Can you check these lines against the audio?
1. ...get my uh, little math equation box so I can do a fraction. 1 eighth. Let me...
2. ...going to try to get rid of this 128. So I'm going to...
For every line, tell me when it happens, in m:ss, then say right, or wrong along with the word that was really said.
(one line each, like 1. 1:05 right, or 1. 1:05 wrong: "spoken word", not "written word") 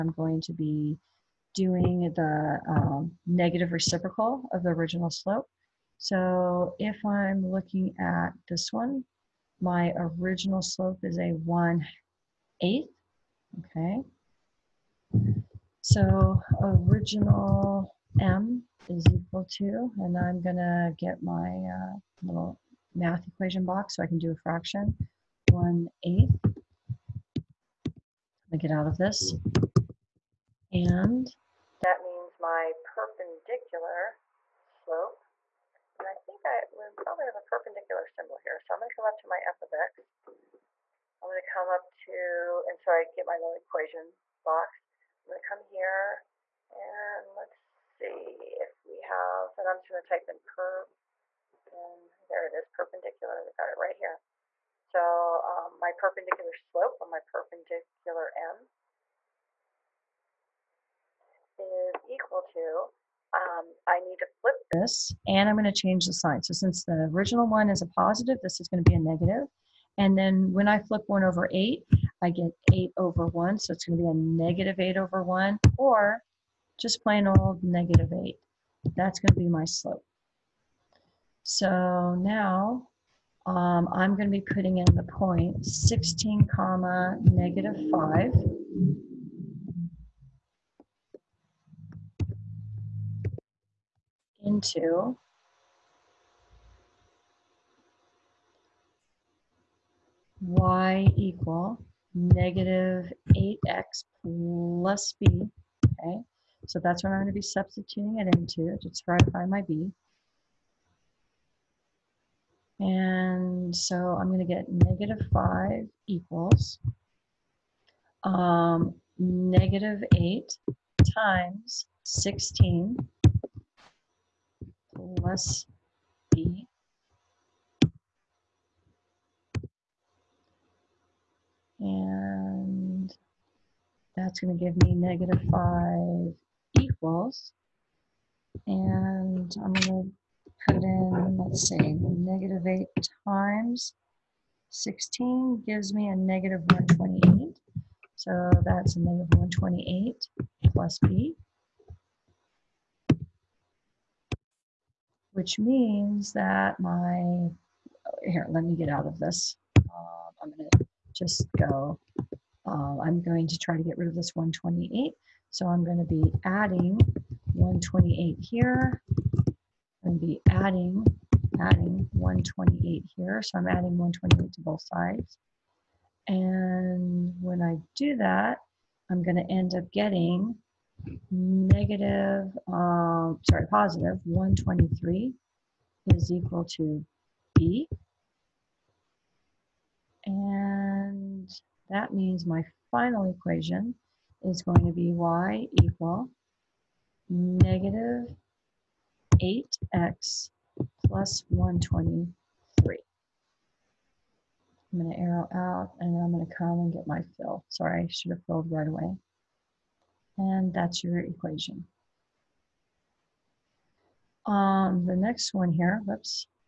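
1. 0:20 right
2. 2:43 right.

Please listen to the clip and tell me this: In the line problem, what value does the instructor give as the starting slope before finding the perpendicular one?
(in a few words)
1/8.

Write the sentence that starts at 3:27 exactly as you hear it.
Sorry, I should have filled right away.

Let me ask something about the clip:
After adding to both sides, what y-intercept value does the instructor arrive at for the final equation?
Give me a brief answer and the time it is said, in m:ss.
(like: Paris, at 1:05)
123, at 3:03.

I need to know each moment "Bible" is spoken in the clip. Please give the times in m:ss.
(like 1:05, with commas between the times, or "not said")
not said.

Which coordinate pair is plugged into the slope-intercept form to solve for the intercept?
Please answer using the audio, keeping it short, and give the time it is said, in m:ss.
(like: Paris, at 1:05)
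(16, -5), at 1:25.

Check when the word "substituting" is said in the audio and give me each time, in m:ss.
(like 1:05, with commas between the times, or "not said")
1:47.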